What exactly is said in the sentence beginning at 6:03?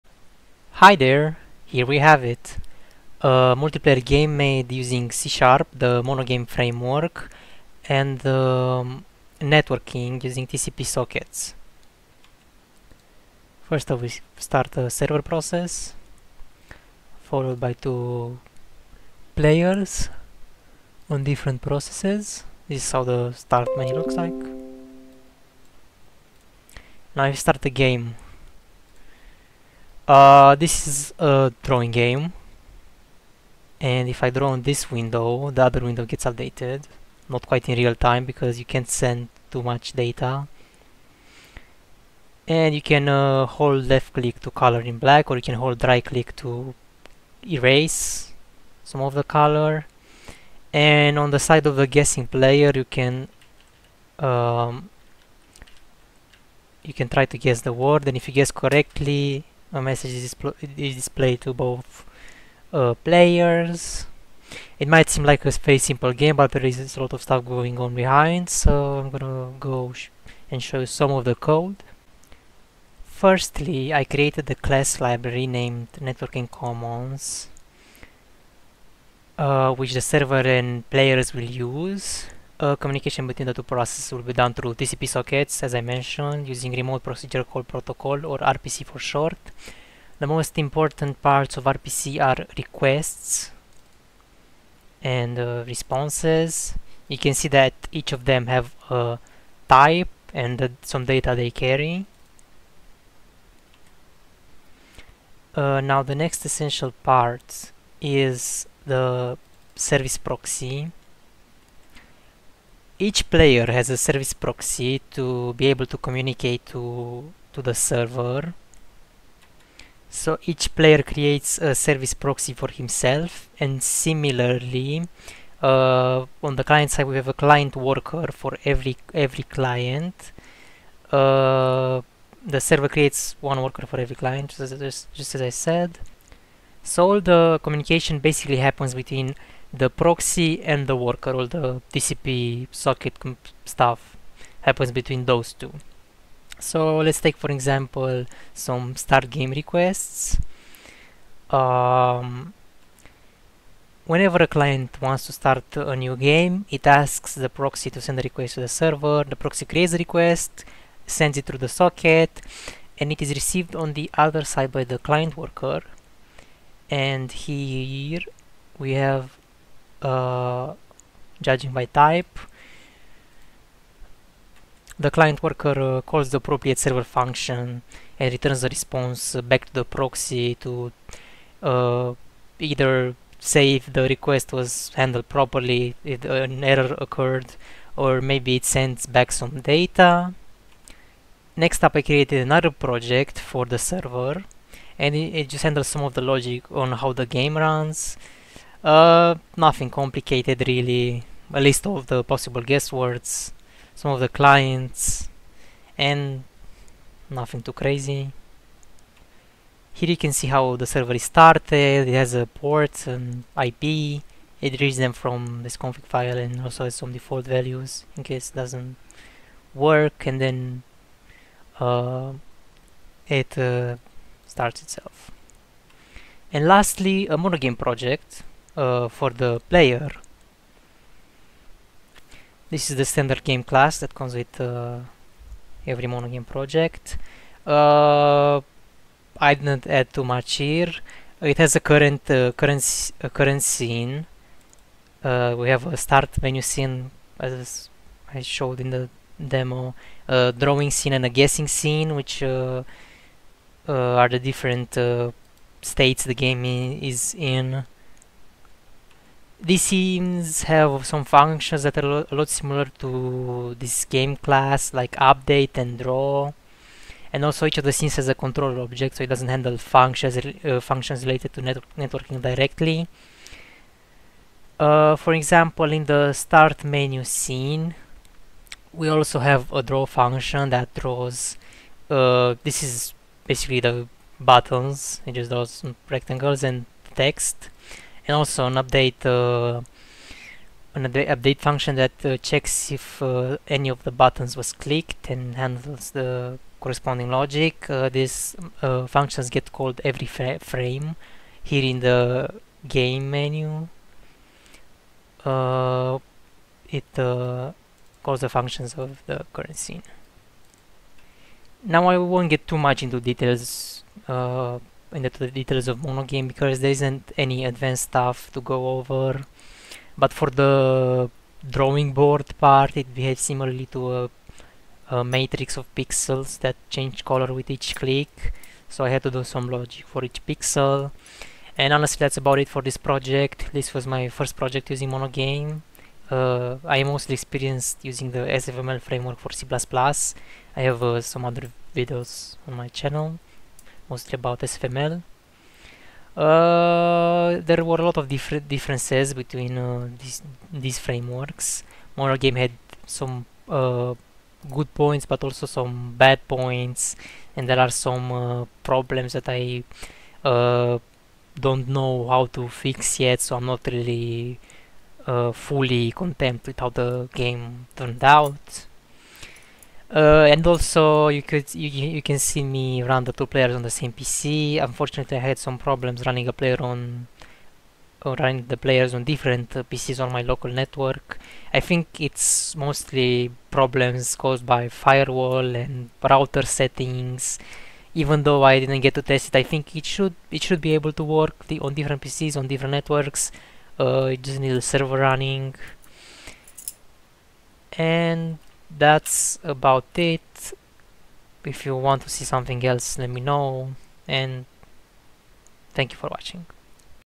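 So I'm not really uh, fully content with how the game turned out.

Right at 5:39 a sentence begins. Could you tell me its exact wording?
I have uh, some other videos on my channel mostly about SFML.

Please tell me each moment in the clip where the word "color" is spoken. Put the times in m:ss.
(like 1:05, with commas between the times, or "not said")
0:44, 0:49, 5:27.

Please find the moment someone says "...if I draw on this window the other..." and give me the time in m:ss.
0:34.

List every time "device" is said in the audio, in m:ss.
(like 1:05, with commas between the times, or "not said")
not said.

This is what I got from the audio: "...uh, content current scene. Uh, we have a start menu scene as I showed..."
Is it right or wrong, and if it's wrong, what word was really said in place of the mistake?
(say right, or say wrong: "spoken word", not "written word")
wrong: "current", not "content".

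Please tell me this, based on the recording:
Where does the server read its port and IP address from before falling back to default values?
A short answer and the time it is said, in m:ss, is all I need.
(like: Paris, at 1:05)
config file, at 3:35.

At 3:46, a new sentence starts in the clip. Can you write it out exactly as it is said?
And lastly, a monogame project uh, for the player.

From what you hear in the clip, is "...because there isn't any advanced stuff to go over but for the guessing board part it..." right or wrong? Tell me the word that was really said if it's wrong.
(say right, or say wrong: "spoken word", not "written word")
wrong: "drawing", not "guessing".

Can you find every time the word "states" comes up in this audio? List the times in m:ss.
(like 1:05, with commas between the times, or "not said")
4:15.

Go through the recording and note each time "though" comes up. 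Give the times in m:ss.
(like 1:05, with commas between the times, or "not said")
6:28.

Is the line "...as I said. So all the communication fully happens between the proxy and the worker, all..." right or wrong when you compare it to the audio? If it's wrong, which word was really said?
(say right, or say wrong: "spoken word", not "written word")
wrong: "basically", not "fully".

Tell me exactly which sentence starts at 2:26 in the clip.
So let's take for example some start game requests.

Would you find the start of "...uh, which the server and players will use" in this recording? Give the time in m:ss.
1:19.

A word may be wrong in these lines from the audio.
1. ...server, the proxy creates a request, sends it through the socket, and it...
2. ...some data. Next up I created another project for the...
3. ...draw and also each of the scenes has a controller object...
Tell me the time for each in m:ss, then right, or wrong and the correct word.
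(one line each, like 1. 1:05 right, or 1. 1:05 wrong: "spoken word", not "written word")
1. 2:38 right
2. 3:09 right
3. 4:25 right.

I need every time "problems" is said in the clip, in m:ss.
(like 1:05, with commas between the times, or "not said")
5:58, 6:15, 6:23.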